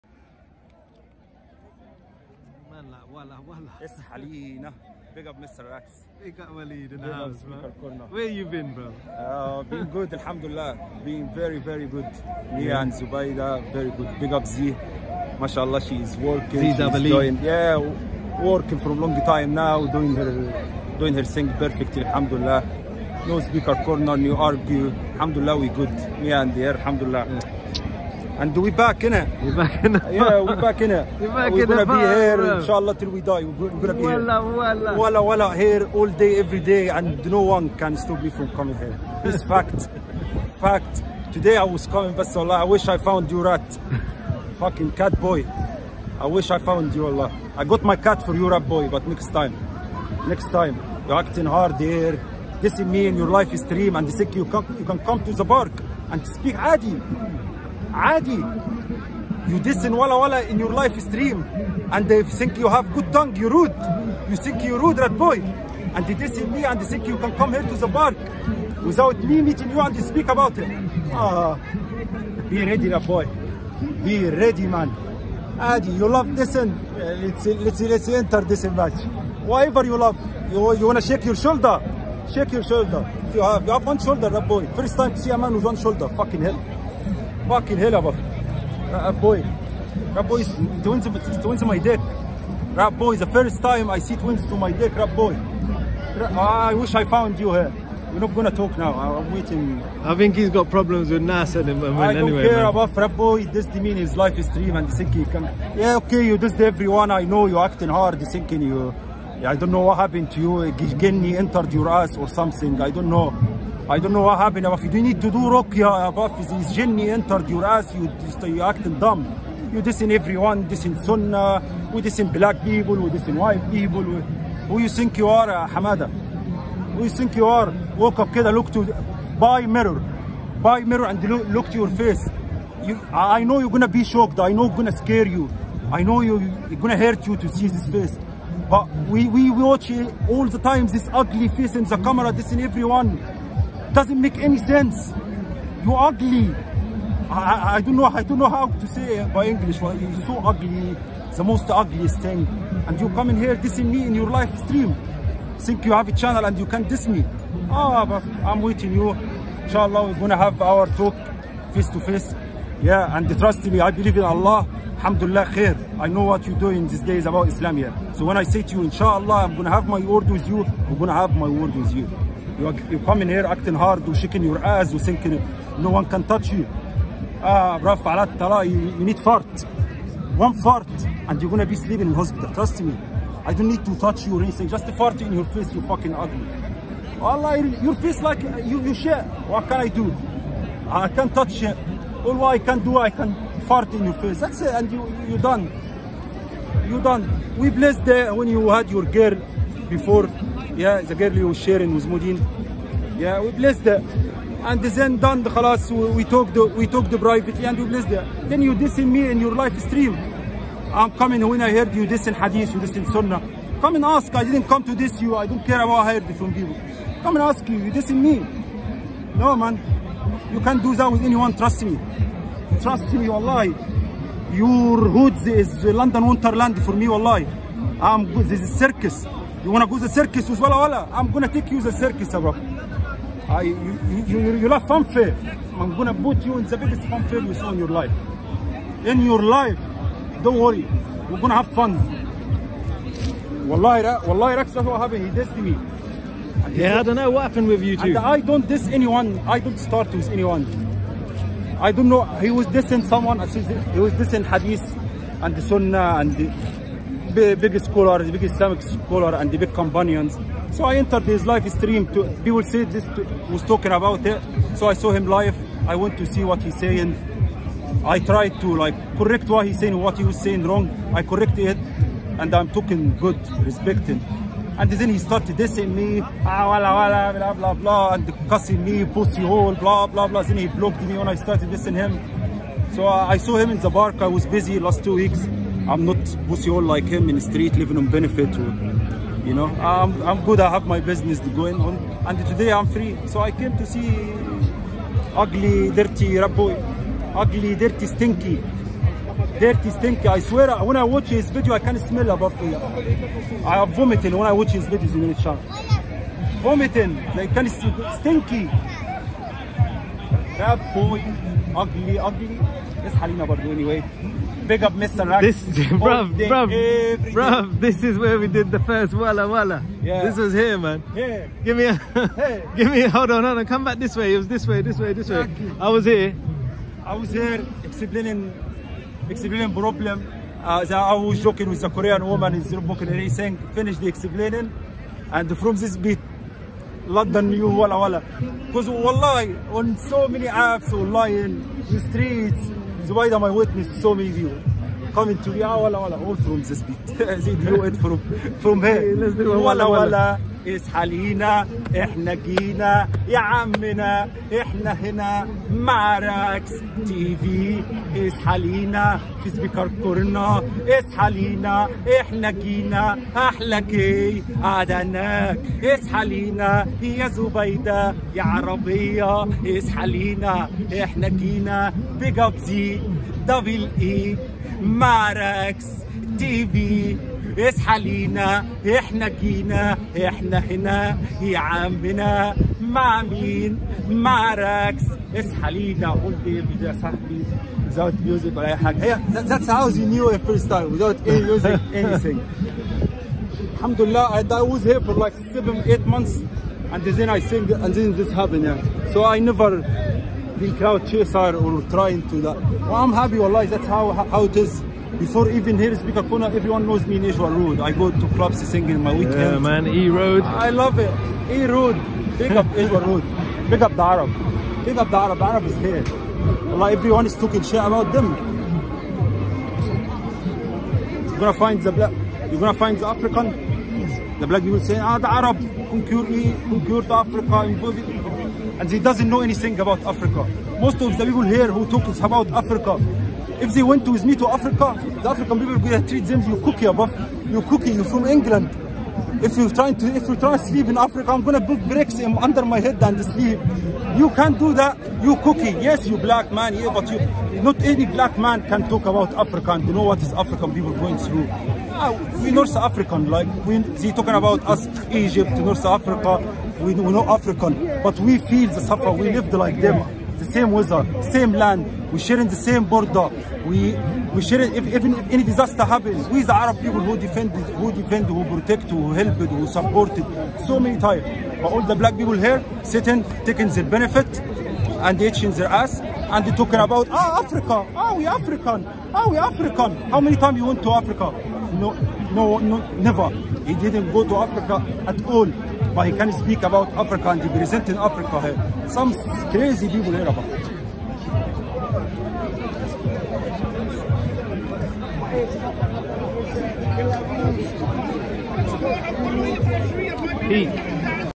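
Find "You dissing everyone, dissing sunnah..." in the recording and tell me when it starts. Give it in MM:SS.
01:59.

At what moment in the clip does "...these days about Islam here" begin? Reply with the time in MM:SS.
02:46.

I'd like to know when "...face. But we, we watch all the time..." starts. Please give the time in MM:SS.
02:17.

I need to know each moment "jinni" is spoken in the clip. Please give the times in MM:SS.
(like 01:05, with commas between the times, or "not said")
01:51, 01:56.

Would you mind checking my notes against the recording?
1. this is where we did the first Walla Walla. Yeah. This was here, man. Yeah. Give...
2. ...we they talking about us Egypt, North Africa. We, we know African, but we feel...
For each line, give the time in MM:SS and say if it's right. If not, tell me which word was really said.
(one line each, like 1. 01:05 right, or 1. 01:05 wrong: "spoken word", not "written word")
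1. 05:17 right
2. 07:33 right.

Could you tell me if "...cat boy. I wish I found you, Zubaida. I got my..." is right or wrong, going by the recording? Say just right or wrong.
wrong.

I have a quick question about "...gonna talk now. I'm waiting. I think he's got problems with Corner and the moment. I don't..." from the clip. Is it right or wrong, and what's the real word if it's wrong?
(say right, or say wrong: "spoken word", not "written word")
wrong: "Nas", not "Corner".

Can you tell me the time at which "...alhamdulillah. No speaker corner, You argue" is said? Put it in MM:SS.
00:22.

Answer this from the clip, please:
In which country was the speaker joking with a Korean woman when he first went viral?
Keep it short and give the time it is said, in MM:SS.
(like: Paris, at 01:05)
Zimbabwe, at 05:32.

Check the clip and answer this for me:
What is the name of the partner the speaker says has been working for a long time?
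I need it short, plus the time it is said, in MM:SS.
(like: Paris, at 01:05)
Zubaida, at 00:12.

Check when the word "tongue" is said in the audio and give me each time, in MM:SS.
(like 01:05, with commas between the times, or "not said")
01:03.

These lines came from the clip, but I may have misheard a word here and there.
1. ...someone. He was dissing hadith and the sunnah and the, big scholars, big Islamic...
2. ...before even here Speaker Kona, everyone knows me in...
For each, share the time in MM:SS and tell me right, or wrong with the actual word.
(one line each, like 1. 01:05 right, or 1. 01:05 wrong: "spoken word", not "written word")
1. 04:13 right
2. 06:45 right.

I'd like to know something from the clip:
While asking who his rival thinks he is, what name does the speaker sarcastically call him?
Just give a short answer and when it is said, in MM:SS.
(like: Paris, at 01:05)
Hamada, at 02:05.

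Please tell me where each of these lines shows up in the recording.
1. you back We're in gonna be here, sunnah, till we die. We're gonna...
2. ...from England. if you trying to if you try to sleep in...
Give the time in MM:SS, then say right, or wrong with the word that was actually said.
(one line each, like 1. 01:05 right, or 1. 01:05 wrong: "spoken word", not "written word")
1. 00:31 wrong: "inshallah", not "sunnah"
2. 07:18 right.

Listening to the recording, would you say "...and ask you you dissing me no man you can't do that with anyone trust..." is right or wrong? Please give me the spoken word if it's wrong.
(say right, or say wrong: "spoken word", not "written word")
right.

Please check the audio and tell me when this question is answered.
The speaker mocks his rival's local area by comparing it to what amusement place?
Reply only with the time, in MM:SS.
03:45.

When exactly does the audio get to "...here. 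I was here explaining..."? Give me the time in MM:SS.
05:26.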